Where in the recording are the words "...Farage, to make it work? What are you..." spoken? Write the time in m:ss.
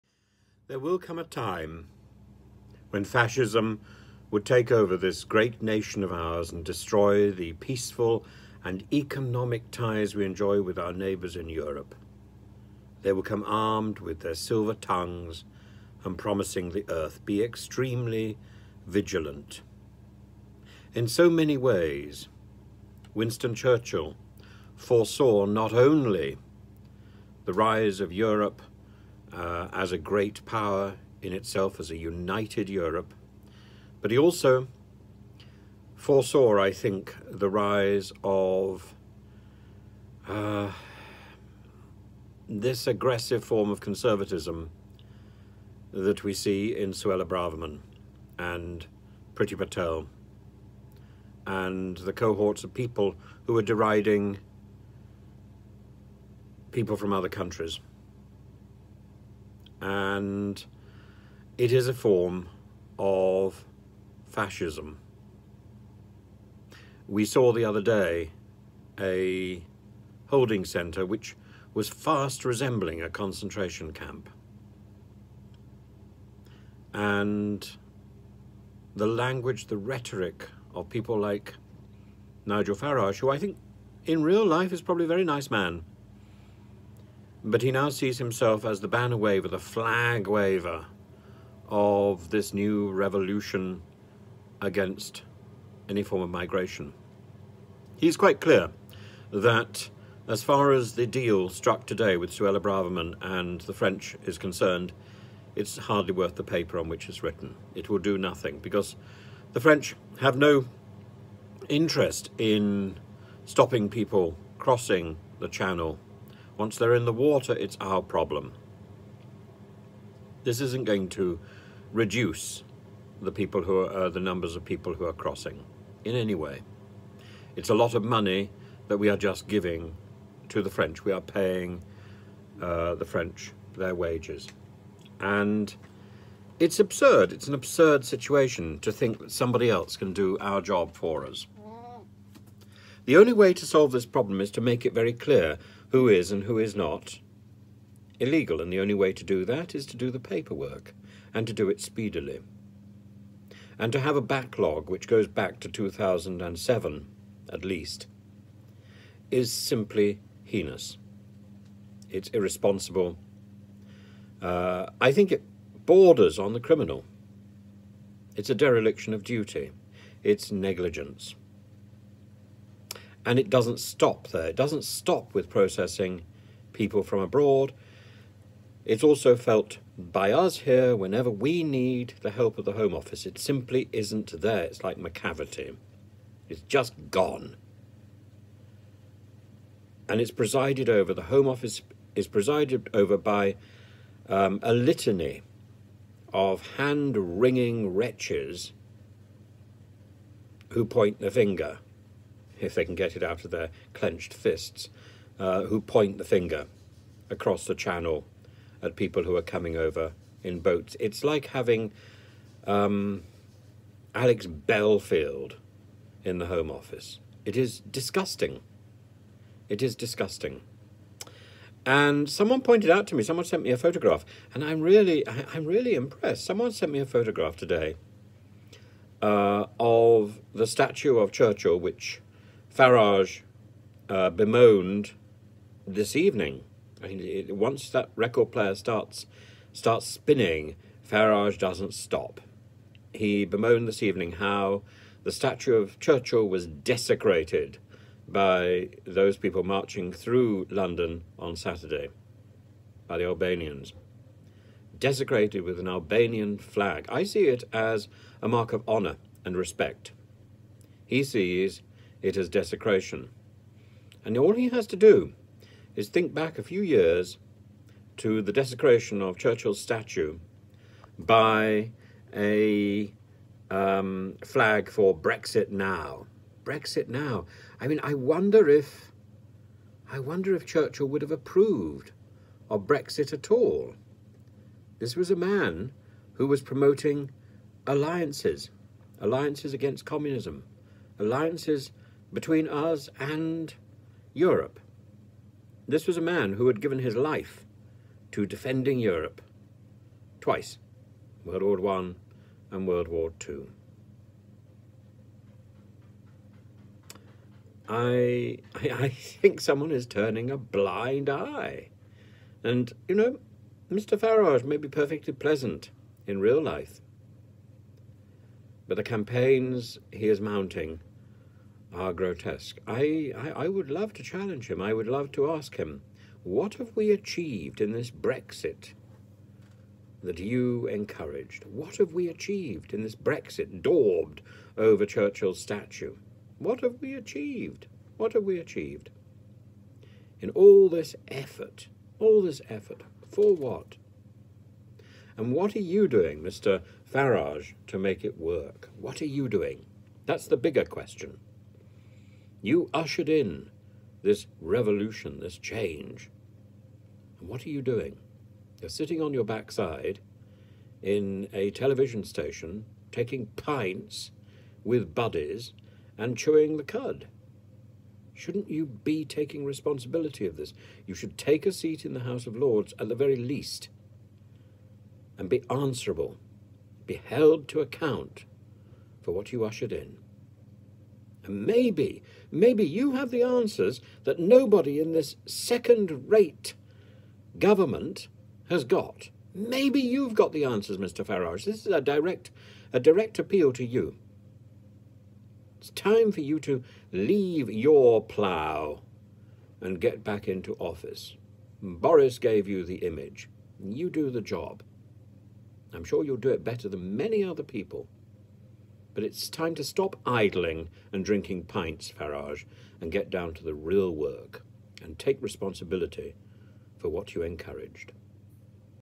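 5:47.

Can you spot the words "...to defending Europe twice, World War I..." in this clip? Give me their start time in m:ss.
4:58.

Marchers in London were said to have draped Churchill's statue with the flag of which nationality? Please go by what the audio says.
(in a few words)
Albanian.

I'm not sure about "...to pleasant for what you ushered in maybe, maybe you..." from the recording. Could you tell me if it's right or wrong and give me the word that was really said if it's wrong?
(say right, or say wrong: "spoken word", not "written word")
wrong: "account", not "pleasant".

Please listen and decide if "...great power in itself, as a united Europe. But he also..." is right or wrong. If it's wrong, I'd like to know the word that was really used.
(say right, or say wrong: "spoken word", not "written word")
right.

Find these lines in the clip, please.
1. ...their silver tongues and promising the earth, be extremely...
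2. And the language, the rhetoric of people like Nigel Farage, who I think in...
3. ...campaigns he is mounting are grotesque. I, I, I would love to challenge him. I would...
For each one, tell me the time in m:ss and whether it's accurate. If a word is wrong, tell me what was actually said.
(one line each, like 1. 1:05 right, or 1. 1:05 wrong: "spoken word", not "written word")
1. 0:14 right
2. 1:16 right
3. 5:19 right.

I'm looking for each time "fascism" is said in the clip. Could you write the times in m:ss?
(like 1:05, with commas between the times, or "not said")
0:03, 1:04.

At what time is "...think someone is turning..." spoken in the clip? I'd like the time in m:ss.
5:09.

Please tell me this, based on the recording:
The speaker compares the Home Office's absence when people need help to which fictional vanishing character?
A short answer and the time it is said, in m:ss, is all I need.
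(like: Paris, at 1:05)
Macavity, at 3:04.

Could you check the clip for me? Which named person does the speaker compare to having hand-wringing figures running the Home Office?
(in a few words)
Alex Belfield.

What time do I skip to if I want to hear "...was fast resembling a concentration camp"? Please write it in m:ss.
1:11.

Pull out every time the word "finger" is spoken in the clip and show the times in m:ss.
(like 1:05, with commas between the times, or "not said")
3:21, 3:26.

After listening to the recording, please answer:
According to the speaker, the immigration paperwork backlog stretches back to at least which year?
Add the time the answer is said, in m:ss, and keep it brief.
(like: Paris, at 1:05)
2007, at 2:35.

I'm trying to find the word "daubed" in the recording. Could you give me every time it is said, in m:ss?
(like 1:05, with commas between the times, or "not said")
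5:33.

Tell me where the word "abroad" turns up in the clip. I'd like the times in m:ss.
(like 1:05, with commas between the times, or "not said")
2:57.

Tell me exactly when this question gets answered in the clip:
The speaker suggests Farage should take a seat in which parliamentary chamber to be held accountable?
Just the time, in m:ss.
6:12.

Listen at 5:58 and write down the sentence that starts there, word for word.
You're sitting on your backside in a television station, taking pints with buddies and chewing the cud.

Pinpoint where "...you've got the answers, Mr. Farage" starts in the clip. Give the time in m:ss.
6:29.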